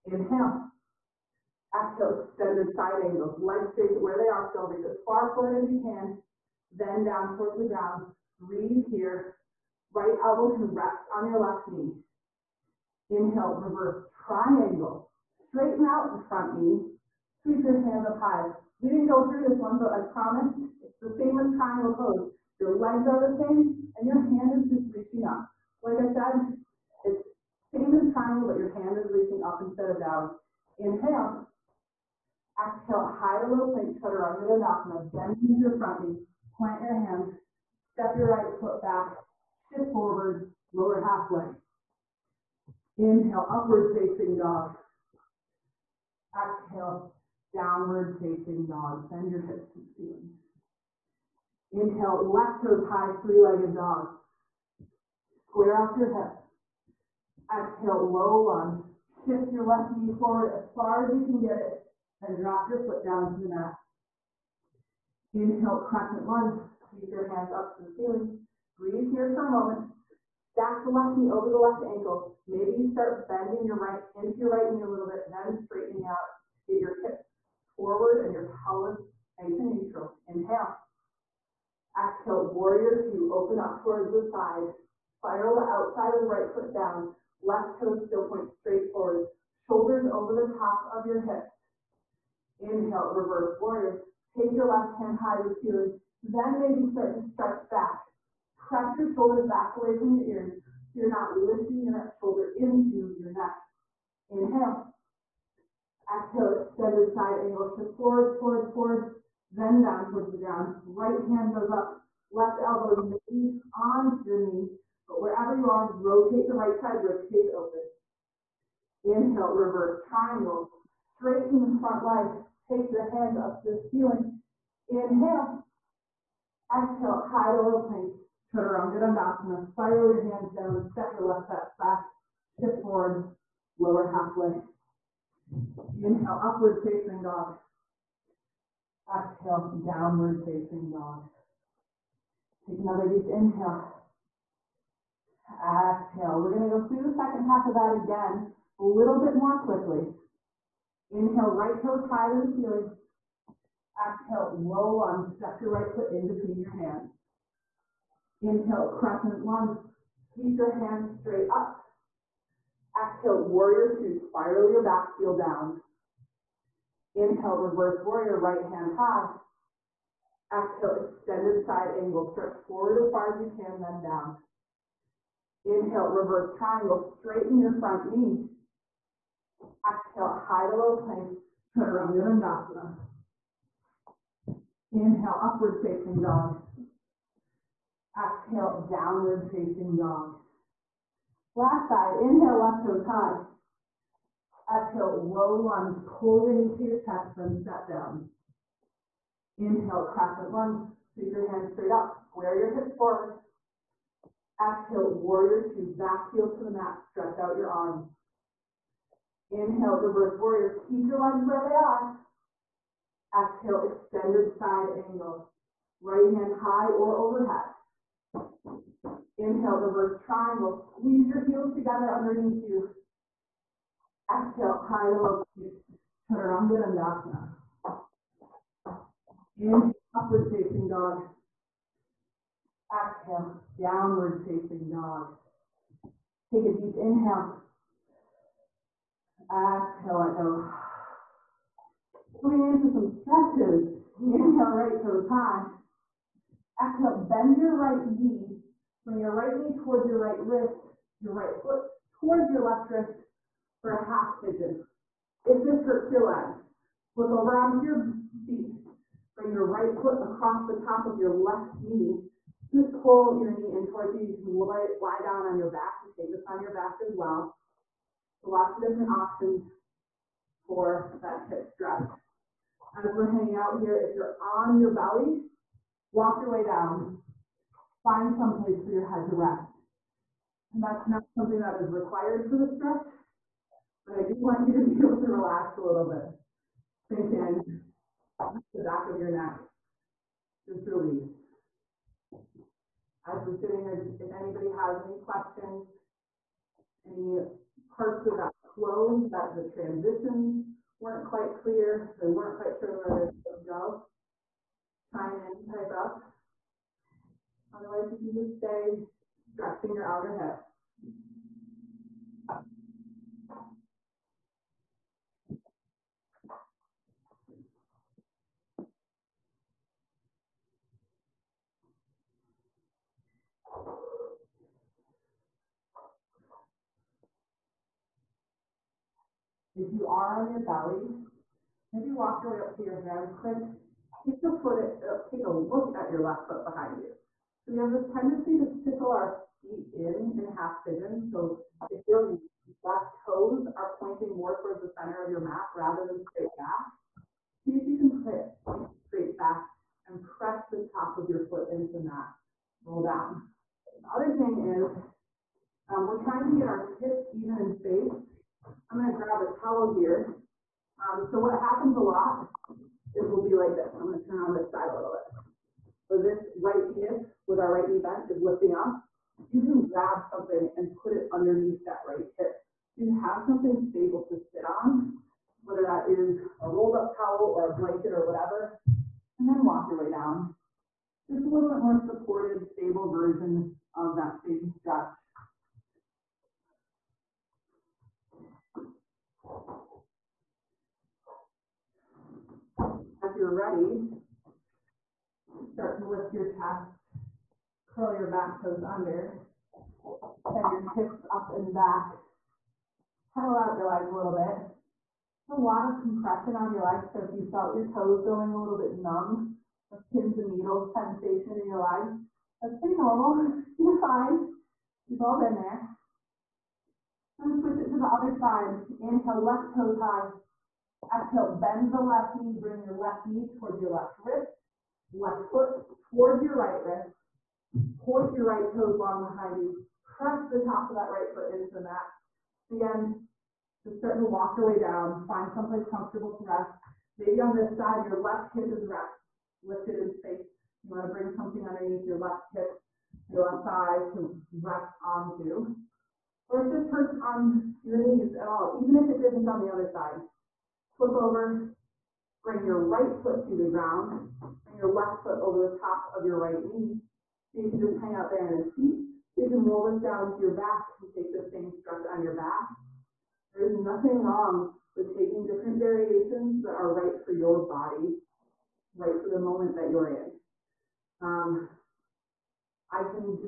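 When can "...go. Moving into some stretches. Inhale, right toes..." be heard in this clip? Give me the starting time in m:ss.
4:00.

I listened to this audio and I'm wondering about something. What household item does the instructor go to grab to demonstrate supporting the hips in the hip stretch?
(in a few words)
A towel.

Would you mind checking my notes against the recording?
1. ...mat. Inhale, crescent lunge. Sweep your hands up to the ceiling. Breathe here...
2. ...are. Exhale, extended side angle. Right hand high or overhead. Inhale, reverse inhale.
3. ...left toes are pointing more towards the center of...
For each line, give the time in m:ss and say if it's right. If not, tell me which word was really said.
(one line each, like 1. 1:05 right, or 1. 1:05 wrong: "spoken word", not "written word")
1. 1:03 right
2. 3:31 wrong: "triangle", not "inhale"
3. 5:42 right.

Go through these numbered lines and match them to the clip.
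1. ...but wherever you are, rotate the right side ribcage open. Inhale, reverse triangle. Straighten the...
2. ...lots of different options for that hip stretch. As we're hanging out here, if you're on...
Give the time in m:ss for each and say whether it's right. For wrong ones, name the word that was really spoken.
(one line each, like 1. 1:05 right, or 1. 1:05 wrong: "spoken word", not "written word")
1. 1:55 right
2. 4:28 right.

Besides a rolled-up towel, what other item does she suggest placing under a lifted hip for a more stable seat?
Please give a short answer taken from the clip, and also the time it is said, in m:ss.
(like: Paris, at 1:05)
A blanket, at 6:17.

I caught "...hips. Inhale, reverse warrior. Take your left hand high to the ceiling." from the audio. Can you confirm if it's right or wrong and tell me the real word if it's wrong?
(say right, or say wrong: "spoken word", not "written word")
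right.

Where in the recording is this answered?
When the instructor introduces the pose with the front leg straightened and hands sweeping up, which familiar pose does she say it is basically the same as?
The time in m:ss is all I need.
0:21.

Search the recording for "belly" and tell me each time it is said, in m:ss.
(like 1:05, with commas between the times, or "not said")
4:34, 5:30.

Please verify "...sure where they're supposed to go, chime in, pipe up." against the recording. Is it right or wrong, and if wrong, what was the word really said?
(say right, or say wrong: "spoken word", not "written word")
right.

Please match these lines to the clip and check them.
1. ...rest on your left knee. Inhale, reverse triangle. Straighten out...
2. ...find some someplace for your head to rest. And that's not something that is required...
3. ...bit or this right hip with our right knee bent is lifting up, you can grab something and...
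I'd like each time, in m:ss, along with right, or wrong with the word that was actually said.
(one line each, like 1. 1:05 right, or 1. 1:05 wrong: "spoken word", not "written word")
1. 0:10 right
2. 4:38 wrong: "place", not "someplace"
3. 6:05 right.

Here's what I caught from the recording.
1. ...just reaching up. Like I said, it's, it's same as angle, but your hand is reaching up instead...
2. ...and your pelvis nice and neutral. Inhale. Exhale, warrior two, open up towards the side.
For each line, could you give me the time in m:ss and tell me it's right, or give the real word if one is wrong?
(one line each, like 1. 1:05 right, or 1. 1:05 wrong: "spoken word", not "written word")
1. 0:24 wrong: "triangle", not "angle"
2. 1:18 right.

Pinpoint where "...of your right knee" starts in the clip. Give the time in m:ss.
7:36.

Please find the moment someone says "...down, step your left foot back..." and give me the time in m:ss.
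2:10.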